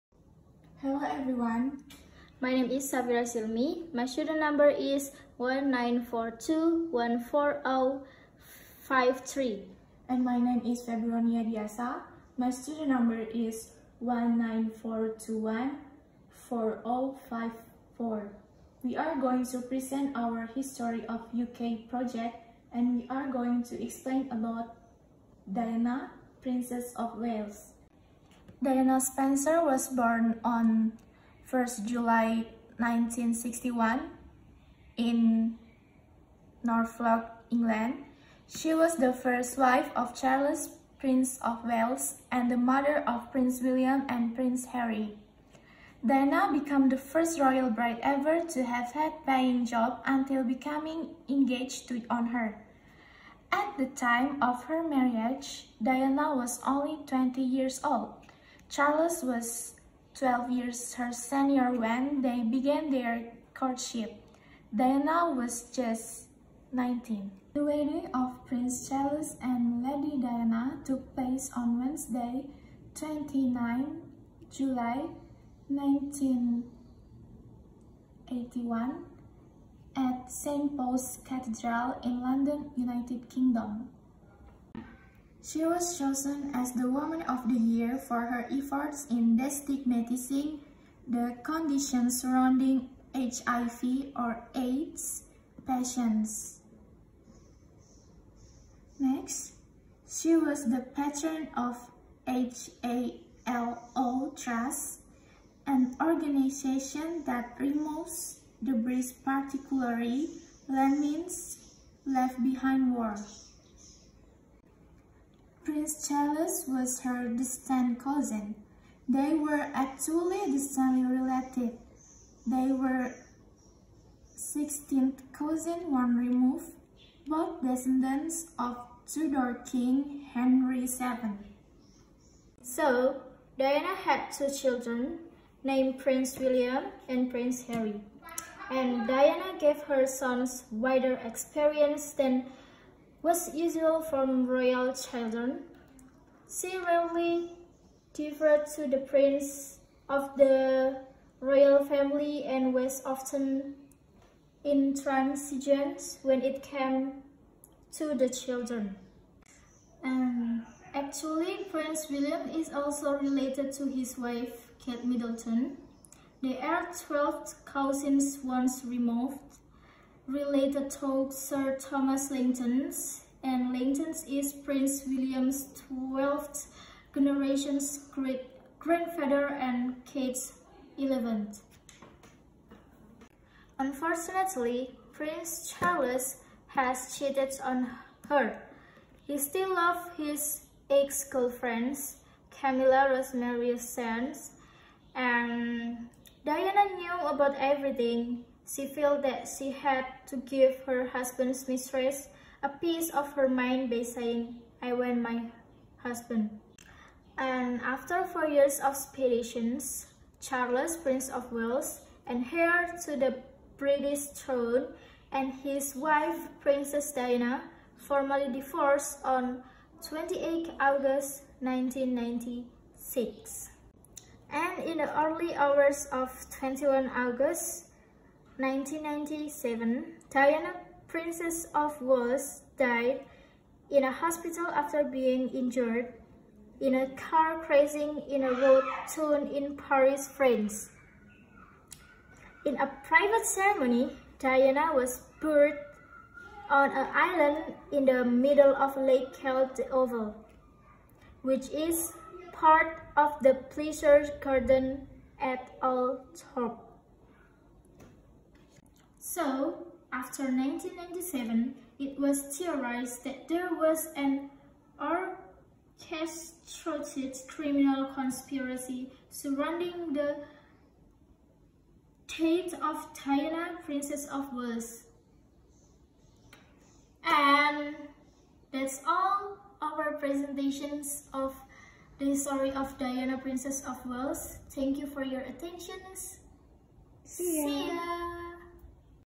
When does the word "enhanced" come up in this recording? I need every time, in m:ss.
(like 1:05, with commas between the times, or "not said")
not said.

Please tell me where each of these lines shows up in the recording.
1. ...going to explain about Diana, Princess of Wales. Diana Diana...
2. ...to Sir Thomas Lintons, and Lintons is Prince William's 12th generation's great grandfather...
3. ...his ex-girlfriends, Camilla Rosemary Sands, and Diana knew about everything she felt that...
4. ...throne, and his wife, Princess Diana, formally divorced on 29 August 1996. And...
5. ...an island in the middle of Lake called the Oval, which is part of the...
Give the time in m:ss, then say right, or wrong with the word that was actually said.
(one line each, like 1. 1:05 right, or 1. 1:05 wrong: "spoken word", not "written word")
1. 0:23 wrong: "Spencer", not "Diana"
2. 2:50 right
3. 3:10 right
4. 3:34 wrong: "28", not "29"
5. 4:06 right.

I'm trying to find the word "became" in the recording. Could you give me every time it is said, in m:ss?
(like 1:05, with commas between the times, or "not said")
0:46.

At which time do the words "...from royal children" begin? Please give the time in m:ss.
2:24.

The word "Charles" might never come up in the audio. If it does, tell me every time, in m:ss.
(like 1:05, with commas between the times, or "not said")
0:40, 0:58, 1:08, 1:56, 3:05, 3:30.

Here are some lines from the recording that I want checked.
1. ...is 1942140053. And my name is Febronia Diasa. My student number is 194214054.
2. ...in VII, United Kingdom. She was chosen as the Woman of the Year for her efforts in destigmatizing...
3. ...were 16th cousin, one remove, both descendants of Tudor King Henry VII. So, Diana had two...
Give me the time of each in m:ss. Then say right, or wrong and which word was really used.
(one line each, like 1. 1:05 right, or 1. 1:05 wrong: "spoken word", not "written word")
1. 0:04 right
2. 1:22 wrong: "London", not "VII"
3. 2:02 right.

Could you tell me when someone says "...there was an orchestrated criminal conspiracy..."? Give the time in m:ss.
4:23.